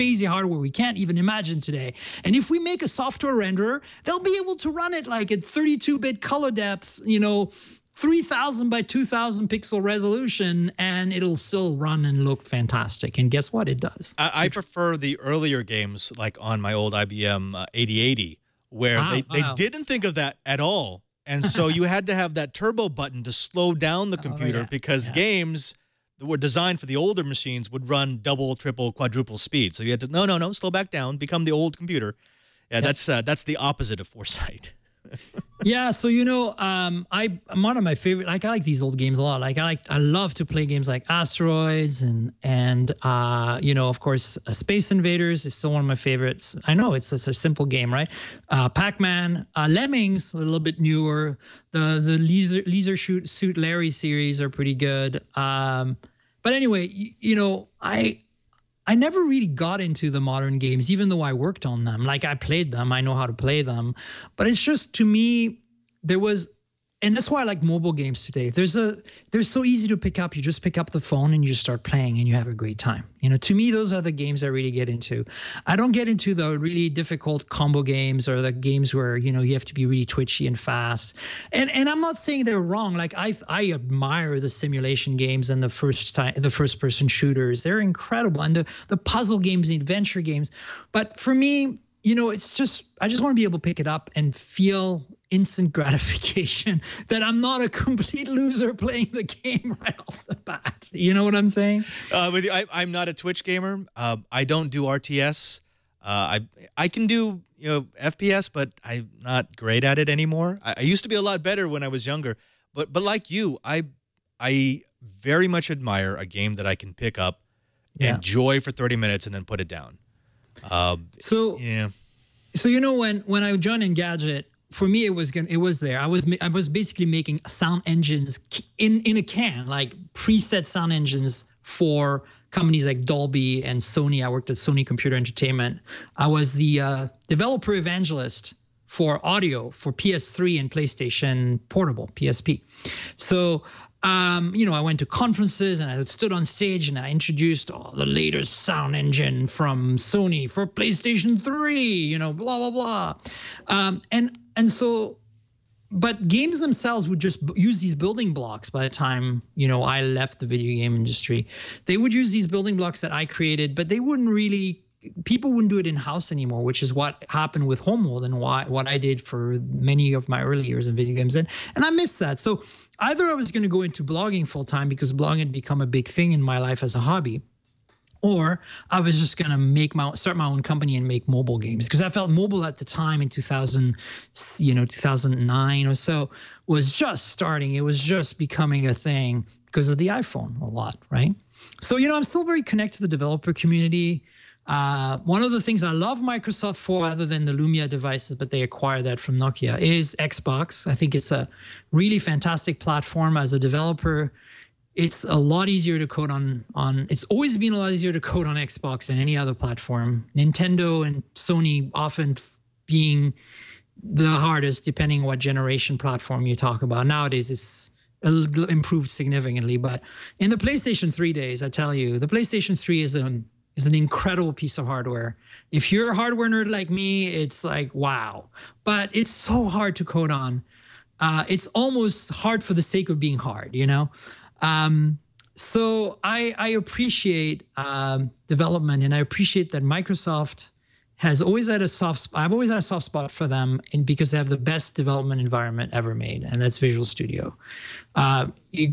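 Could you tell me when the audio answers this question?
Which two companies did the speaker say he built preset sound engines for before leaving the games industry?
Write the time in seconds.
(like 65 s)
133 s.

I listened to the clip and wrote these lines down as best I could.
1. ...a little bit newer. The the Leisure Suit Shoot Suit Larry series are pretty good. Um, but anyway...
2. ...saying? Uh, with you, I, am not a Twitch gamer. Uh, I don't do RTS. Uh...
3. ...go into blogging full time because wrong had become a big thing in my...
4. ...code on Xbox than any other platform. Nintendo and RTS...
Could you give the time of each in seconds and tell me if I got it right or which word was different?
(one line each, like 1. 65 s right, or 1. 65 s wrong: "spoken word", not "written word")
1. 50 s wrong: "Leisure", not "Suit"
2. 101 s right
3. 173 s wrong: "blogging", not "wrong"
4. 208 s wrong: "Sony", not "RTS".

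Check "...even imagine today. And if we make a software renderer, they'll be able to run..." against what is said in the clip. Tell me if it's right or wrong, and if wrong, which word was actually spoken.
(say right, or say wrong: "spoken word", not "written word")
right.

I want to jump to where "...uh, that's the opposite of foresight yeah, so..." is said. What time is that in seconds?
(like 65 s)
33 s.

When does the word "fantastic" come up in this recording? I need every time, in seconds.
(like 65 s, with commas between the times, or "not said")
12 s, 202 s.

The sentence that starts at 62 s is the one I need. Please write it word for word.
Like I played them, I know how to play them.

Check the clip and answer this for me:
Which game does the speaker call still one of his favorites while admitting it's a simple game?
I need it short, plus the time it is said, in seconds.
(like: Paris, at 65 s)
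Space Invaders, at 44 s.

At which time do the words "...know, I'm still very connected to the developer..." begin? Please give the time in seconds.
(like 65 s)
192 s.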